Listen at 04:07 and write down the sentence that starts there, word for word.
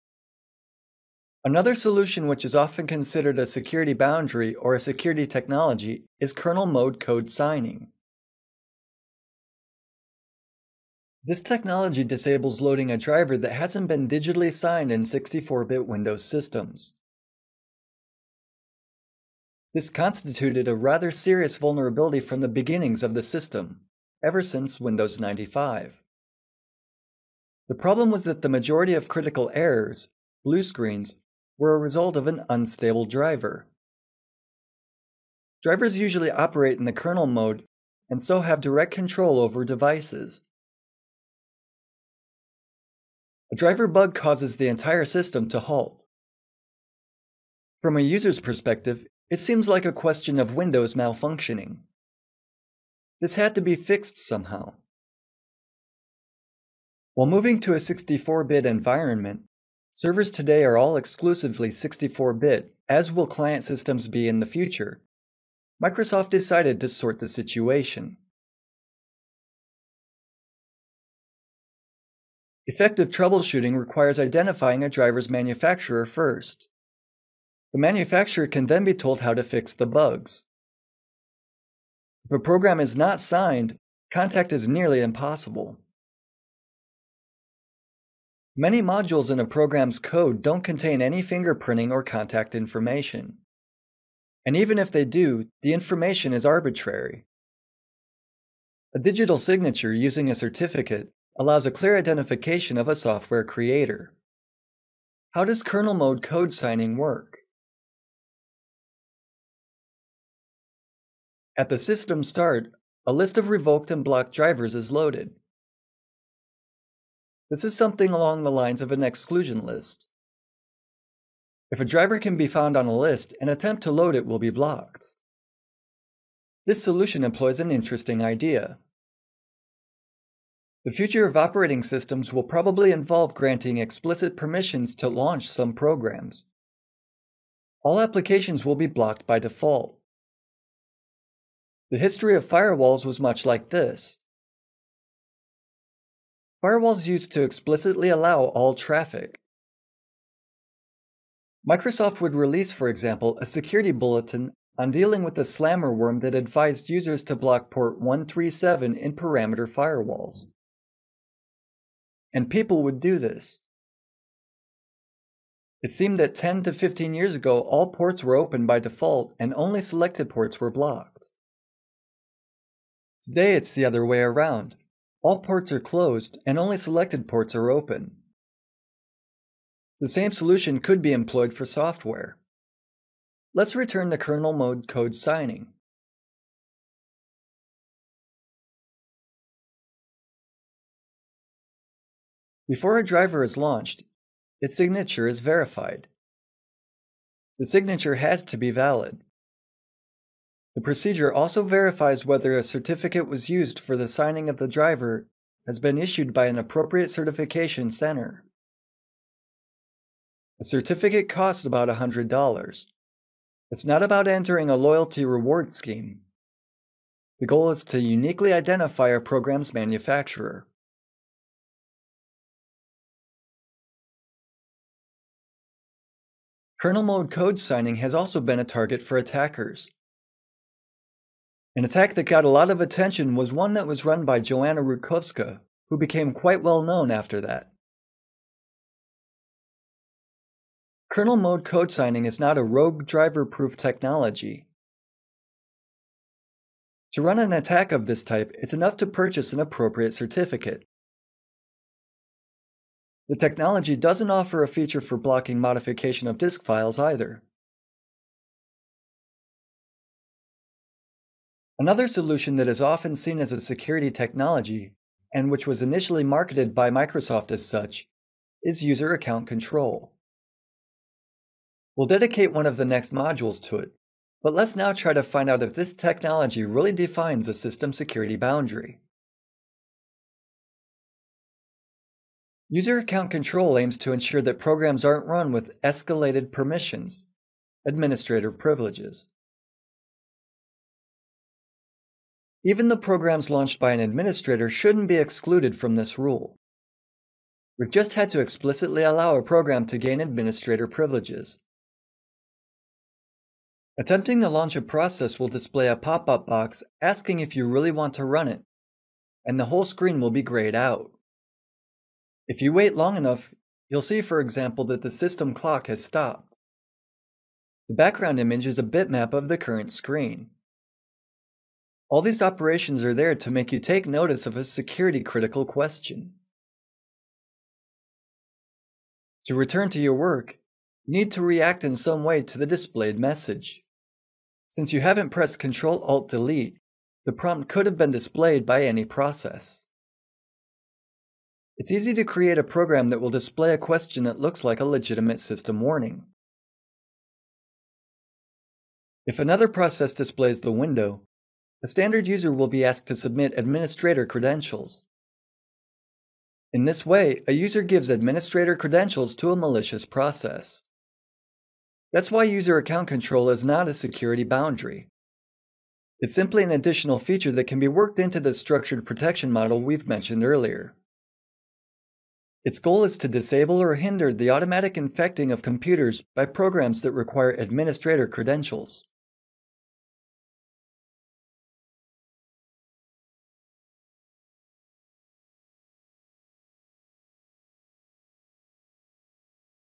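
To run an attack of this type, it's enough to purchase an appropriate certificate.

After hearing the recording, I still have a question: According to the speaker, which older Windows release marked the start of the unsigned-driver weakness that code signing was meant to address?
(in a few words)
Windows 95.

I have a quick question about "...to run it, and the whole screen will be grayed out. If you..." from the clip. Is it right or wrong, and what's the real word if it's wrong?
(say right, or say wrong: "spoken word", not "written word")
right.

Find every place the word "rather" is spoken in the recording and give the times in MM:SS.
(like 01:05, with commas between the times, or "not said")
00:20.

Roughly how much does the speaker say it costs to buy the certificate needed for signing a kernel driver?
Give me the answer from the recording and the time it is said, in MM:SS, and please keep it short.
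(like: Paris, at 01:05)
$100, at 03:31.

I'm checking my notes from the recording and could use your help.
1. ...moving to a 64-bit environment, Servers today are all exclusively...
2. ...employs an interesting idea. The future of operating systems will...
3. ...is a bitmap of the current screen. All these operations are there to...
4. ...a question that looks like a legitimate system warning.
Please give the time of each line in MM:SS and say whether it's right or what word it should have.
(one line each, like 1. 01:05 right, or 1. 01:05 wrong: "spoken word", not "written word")
1. 00:57 right
2. 02:07 right
3. 05:18 right
4. 05:43 right.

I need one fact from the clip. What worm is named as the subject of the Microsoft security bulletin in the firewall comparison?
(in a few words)
slammer worm.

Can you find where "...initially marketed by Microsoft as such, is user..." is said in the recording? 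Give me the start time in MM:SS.
04:25.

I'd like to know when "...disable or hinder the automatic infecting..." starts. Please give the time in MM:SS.
06:13.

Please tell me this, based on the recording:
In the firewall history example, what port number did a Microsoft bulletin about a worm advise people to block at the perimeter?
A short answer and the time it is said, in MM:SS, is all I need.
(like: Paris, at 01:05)
137, at 02:37.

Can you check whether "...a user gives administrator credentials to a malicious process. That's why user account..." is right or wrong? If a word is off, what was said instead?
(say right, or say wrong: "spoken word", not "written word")
right.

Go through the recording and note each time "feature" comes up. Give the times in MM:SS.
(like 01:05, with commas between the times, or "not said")
04:14, 06:07.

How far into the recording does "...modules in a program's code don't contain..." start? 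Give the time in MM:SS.
01:28.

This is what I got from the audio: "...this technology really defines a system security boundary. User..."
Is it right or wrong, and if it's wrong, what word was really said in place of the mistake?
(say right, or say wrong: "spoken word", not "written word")
right.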